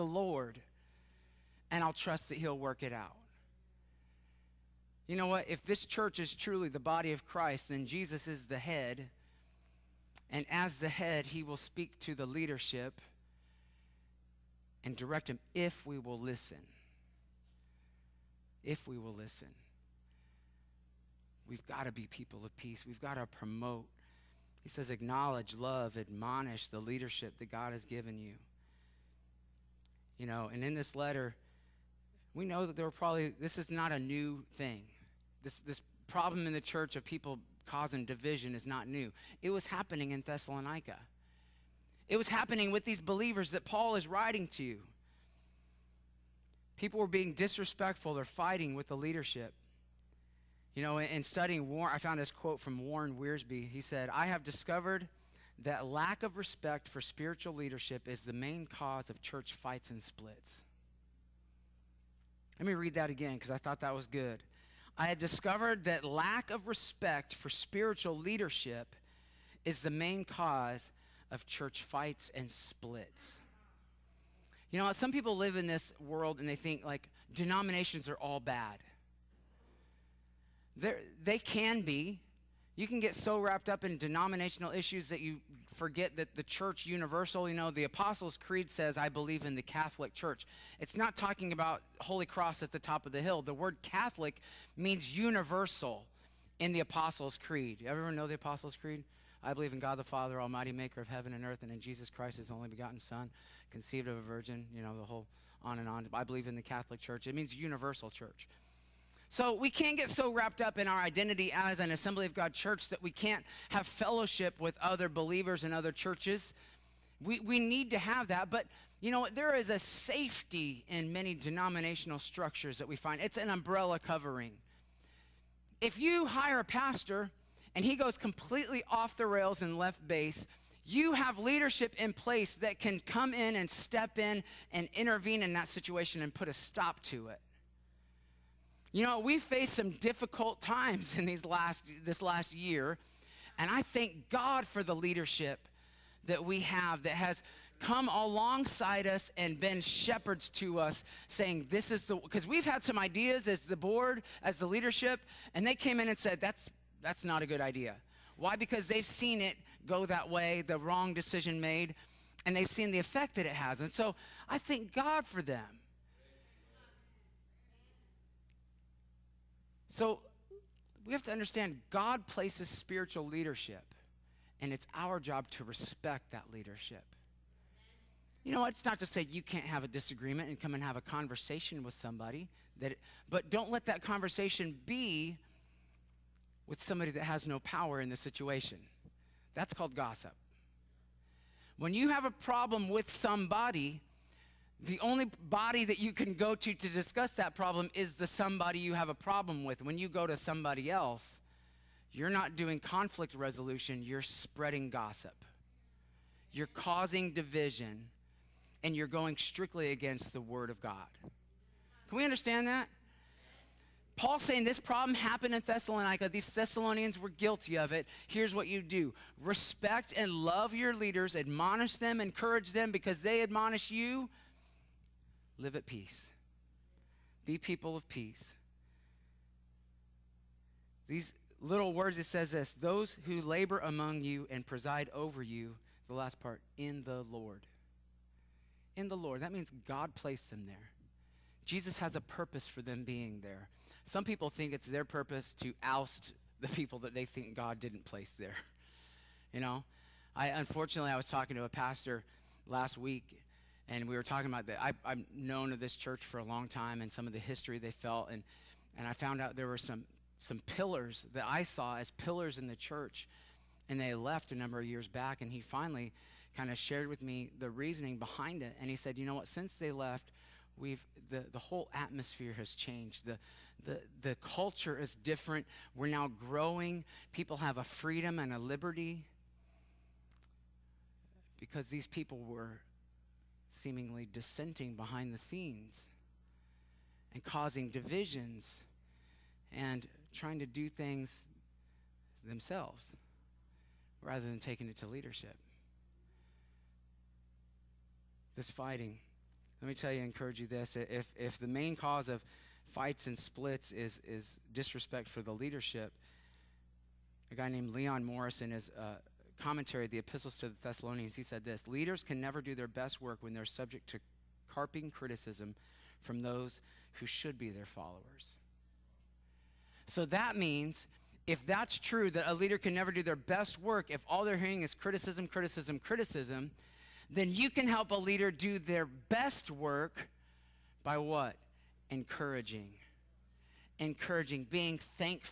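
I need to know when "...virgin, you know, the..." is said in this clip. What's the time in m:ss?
1:44.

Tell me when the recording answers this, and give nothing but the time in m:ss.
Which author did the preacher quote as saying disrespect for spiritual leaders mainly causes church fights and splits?
0:52.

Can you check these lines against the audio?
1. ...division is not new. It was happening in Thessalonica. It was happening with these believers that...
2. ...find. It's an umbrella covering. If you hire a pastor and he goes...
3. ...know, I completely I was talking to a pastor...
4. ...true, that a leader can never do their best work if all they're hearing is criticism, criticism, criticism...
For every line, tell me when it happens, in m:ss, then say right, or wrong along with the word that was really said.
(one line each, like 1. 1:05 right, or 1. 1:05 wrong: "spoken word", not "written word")
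1. 0:38 right
2. 2:02 right
3. 4:09 wrong: "unfortunately", not "completely"
4. 5:21 right.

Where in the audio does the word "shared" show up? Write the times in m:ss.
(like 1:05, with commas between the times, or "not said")
4:26.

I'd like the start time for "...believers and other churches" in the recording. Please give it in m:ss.
1:55.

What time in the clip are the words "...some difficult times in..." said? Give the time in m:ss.
2:19.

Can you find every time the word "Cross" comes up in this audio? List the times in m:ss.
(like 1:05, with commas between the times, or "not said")
1:32.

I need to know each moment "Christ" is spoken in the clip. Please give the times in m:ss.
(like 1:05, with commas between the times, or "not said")
0:07, 1:42.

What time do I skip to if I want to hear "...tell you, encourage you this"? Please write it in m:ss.
4:59.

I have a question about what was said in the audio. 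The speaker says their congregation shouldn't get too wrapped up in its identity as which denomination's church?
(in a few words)
Assembly of God.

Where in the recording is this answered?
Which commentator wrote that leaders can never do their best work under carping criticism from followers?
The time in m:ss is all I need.
5:07.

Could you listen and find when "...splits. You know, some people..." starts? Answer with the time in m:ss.
1:12.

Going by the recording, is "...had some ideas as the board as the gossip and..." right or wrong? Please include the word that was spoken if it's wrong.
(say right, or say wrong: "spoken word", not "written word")
wrong: "leadership", not "gossip".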